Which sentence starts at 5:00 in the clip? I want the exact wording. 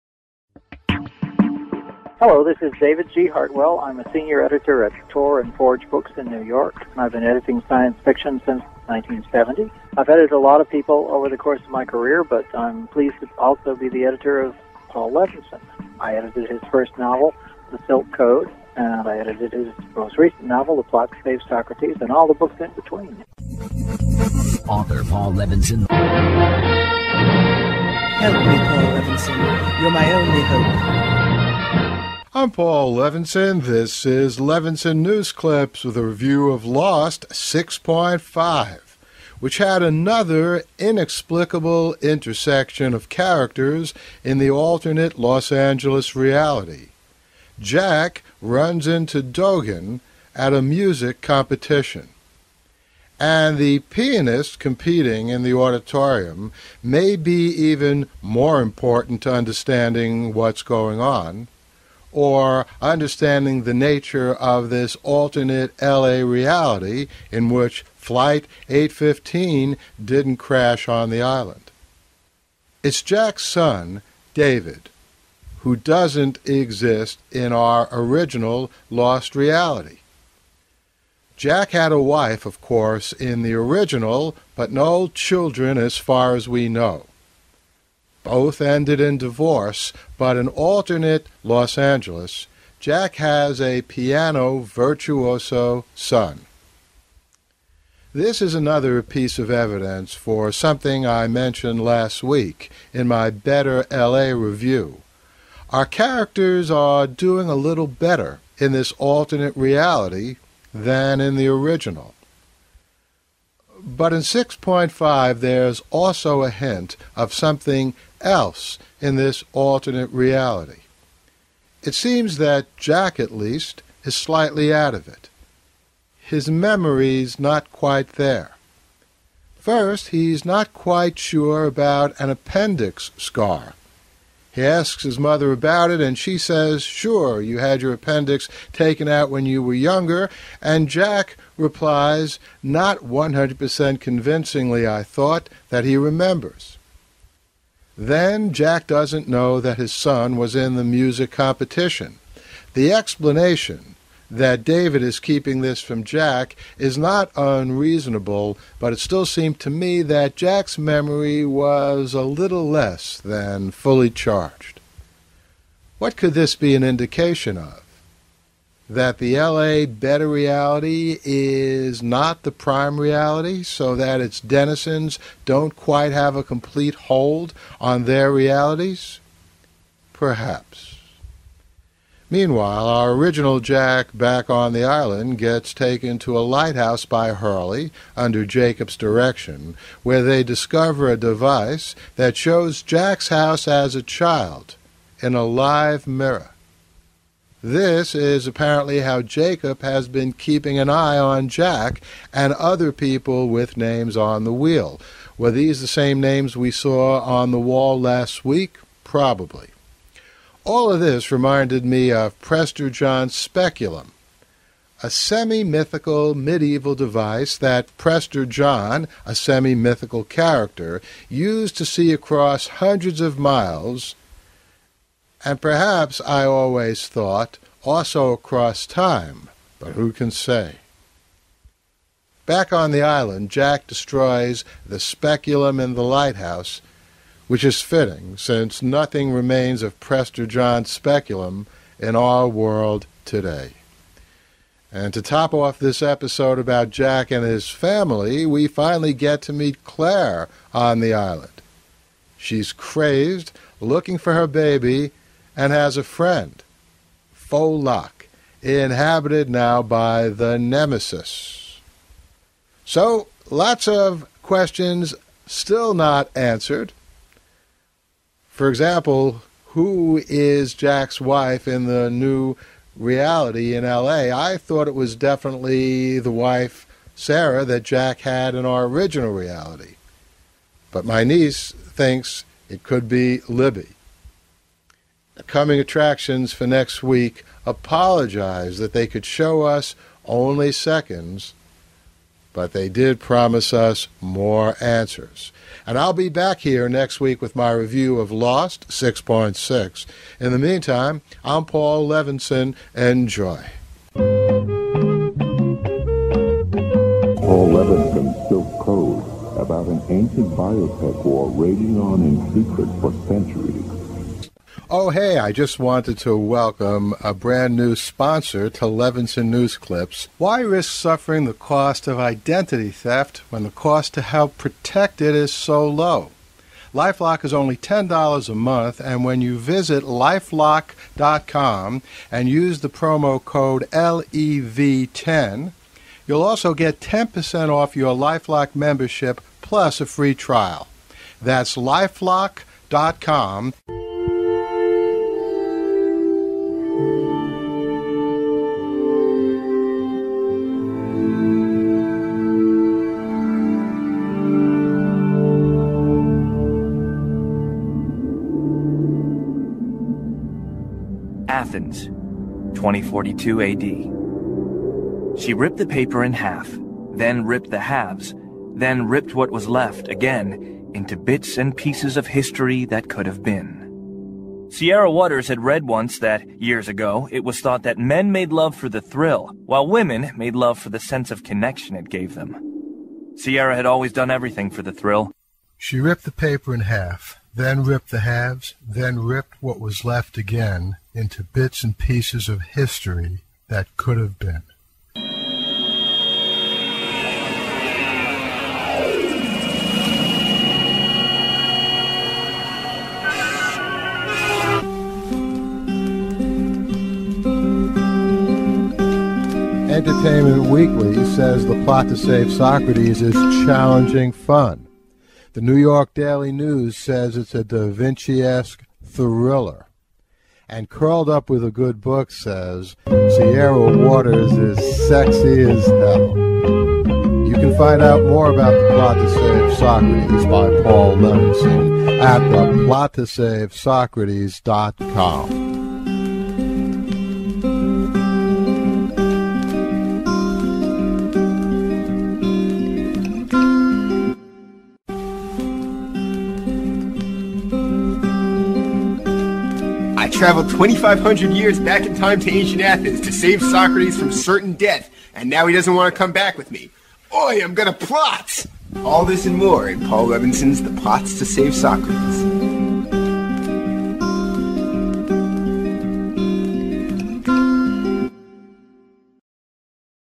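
In the meantime, I'm Paul Levinson.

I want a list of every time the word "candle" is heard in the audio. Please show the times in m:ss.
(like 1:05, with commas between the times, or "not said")
not said.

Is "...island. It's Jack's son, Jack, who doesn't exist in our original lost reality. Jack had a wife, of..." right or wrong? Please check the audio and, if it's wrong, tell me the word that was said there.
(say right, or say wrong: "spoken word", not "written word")
wrong: "David", not "Jack".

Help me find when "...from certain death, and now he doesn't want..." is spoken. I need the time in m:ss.
7:34.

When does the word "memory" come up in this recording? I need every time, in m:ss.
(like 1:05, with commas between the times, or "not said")
2:06, 2:40.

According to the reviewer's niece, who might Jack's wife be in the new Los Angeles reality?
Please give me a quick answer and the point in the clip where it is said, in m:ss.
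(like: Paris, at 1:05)
Libby, at 4:43.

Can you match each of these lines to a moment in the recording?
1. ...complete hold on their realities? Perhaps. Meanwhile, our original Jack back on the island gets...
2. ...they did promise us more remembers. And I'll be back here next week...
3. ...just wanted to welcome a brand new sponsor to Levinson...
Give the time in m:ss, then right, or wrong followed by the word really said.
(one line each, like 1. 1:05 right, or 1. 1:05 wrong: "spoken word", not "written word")
1. 2:56 right
2. 4:52 wrong: "answers", not "remembers"
3. 5:15 right.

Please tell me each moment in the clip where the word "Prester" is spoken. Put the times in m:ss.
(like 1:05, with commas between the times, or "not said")
3:32, 3:37, 3:59.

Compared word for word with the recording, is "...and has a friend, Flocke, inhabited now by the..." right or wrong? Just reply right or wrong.
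right.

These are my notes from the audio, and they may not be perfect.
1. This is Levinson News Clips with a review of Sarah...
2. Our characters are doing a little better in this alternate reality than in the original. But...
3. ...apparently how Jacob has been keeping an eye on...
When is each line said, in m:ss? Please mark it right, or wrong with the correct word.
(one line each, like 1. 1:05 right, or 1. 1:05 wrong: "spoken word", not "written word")
1. 0:33 wrong: "Lost", not "Sarah"
2. 1:45 right
3. 3:18 right.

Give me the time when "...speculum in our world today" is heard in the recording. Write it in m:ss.
4:00.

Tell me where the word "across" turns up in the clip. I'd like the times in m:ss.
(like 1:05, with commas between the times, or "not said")
3:42, 3:48.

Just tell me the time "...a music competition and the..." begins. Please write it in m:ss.
0:50.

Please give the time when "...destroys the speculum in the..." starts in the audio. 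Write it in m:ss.
3:53.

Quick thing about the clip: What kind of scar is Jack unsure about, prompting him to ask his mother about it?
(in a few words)
Appendix scar.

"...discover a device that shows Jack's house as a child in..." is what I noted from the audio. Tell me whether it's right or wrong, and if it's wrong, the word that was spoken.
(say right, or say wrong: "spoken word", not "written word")
right.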